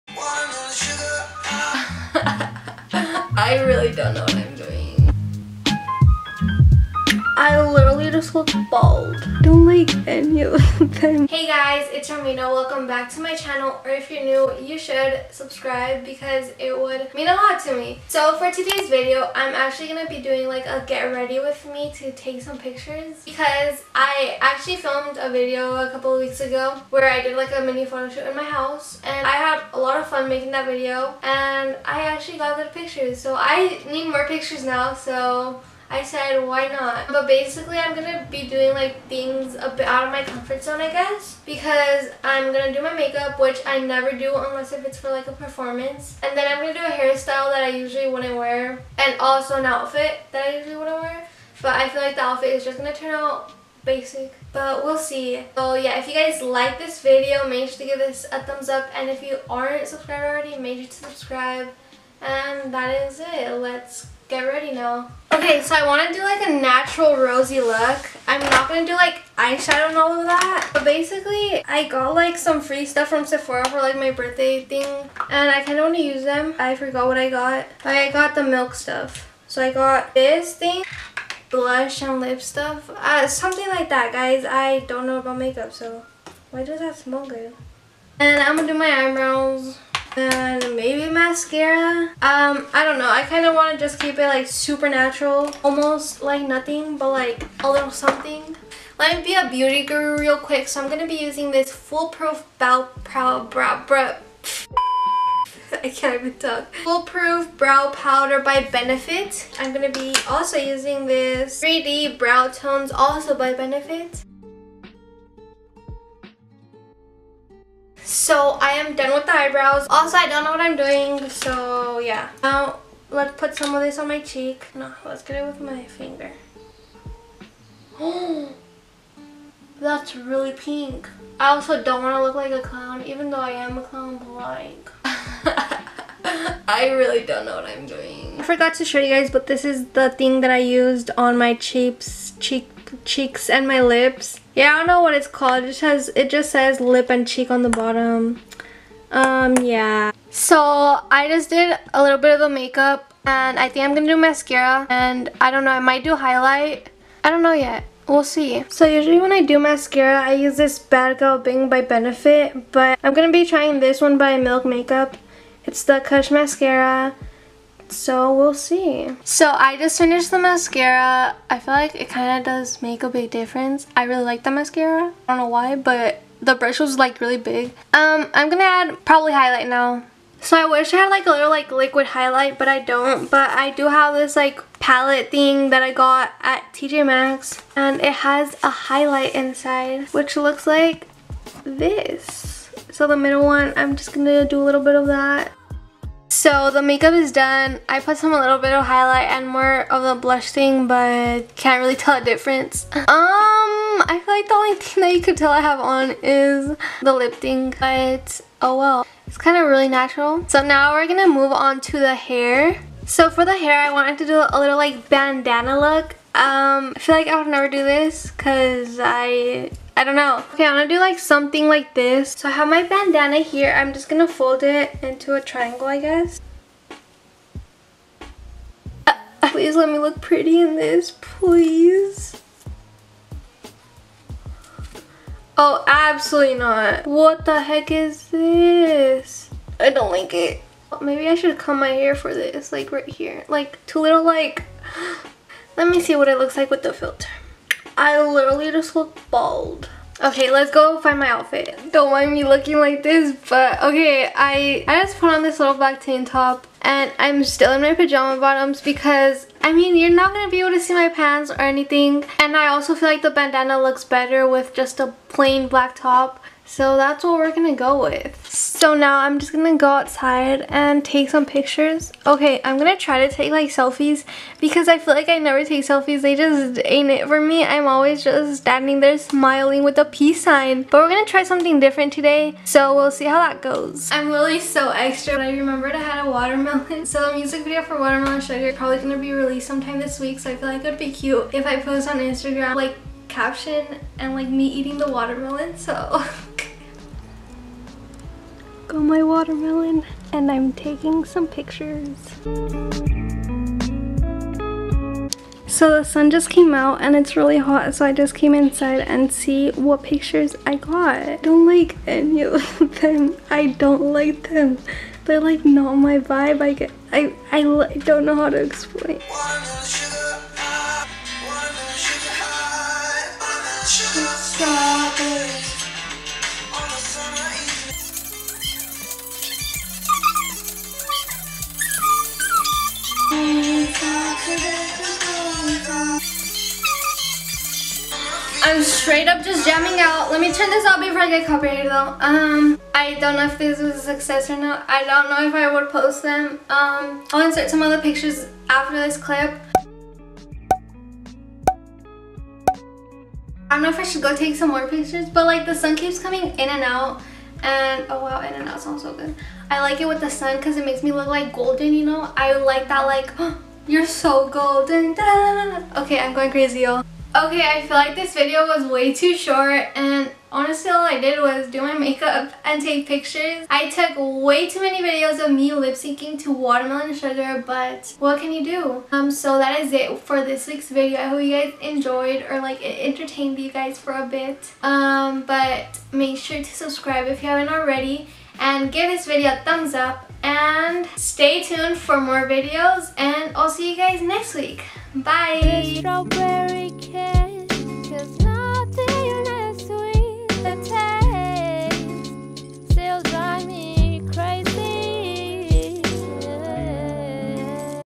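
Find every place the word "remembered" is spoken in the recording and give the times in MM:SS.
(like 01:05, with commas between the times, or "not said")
04:45.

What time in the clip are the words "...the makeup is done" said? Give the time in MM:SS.
03:16.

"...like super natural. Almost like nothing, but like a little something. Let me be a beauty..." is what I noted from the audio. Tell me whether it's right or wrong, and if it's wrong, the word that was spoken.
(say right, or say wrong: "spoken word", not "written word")
right.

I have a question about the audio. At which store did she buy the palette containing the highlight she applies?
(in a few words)
TJ Maxx.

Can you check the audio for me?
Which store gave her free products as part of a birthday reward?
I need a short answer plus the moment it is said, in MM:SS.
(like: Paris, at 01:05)
Sephora, at 01:13.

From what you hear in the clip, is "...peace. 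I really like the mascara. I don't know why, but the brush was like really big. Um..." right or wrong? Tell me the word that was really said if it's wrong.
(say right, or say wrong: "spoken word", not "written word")
wrong: "difference", not "peace".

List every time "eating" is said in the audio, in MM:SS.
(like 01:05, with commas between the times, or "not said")
04:54.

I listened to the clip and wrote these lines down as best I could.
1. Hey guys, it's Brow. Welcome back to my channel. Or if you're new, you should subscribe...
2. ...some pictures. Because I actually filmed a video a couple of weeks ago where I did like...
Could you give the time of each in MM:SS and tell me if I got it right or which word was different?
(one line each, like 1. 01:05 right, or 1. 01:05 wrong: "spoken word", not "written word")
1. 00:11 wrong: "Romina", not "Brow"
2. 00:22 right.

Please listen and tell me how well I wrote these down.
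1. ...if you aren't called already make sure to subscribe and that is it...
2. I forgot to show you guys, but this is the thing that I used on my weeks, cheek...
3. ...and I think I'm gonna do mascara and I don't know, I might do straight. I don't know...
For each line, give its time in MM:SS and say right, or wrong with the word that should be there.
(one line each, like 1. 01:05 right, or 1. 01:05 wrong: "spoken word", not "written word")
1. 00:59 wrong: "subscribed", not "called"
2. 02:18 wrong: "cheeks", not "weeks"
3. 02:33 wrong: "highlight", not "straight".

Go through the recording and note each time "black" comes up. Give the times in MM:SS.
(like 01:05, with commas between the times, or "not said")
04:15, 04:25.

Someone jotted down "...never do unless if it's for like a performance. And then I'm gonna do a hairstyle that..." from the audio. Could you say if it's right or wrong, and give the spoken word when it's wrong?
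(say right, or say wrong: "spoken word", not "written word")
right.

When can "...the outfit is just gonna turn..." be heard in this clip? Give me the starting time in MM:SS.
00:52.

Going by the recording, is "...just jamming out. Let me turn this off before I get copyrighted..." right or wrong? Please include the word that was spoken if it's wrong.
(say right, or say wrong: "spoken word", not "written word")
right.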